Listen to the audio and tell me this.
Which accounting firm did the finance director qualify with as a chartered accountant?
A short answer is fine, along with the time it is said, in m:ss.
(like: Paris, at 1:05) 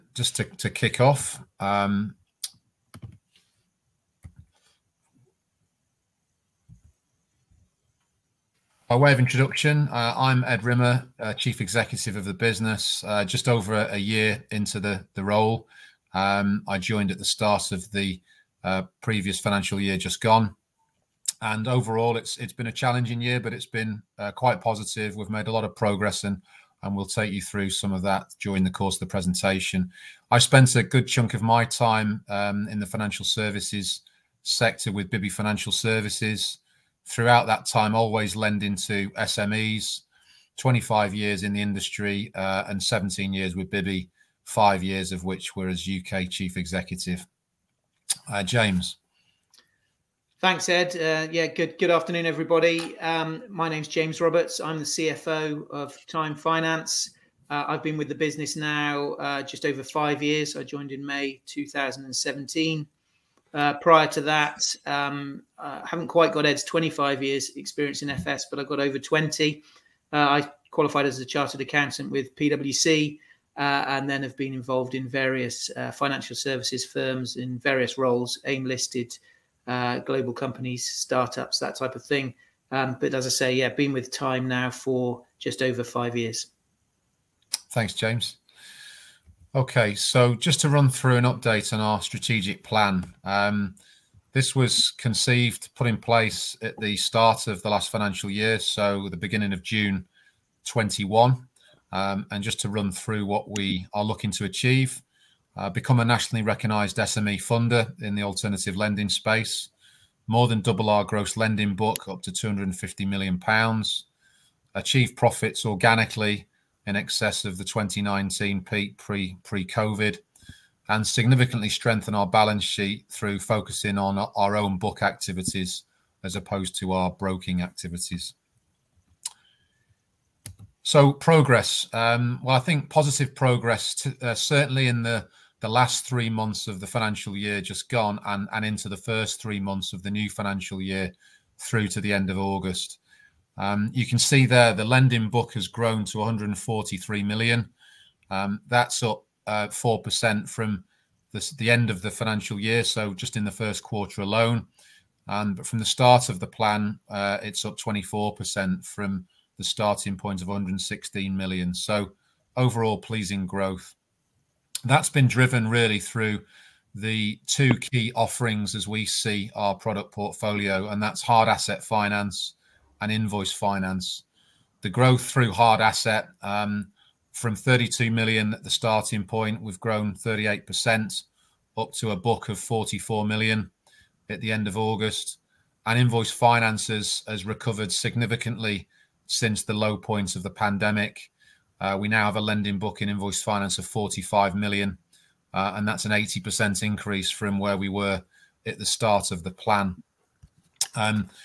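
PwC, at 1:12.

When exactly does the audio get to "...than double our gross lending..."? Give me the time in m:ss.
1:50.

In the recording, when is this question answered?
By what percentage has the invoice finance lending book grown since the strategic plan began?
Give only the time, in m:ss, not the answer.
3:16.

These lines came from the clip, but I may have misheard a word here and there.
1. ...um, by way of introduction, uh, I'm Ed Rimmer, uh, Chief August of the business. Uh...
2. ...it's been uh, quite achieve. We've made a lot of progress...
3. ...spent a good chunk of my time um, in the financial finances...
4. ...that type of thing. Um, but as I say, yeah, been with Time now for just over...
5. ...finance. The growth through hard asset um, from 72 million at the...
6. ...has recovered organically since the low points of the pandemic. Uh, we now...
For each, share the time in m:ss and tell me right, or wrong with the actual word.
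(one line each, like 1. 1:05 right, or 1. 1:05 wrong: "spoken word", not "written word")
1. 0:01 wrong: "Executive", not "August"
2. 0:23 wrong: "positive", not "achieve"
3. 0:30 wrong: "services", not "finances"
4. 1:21 right
5. 2:53 wrong: "32", not "72"
6. 3:07 wrong: "significantly", not "organically".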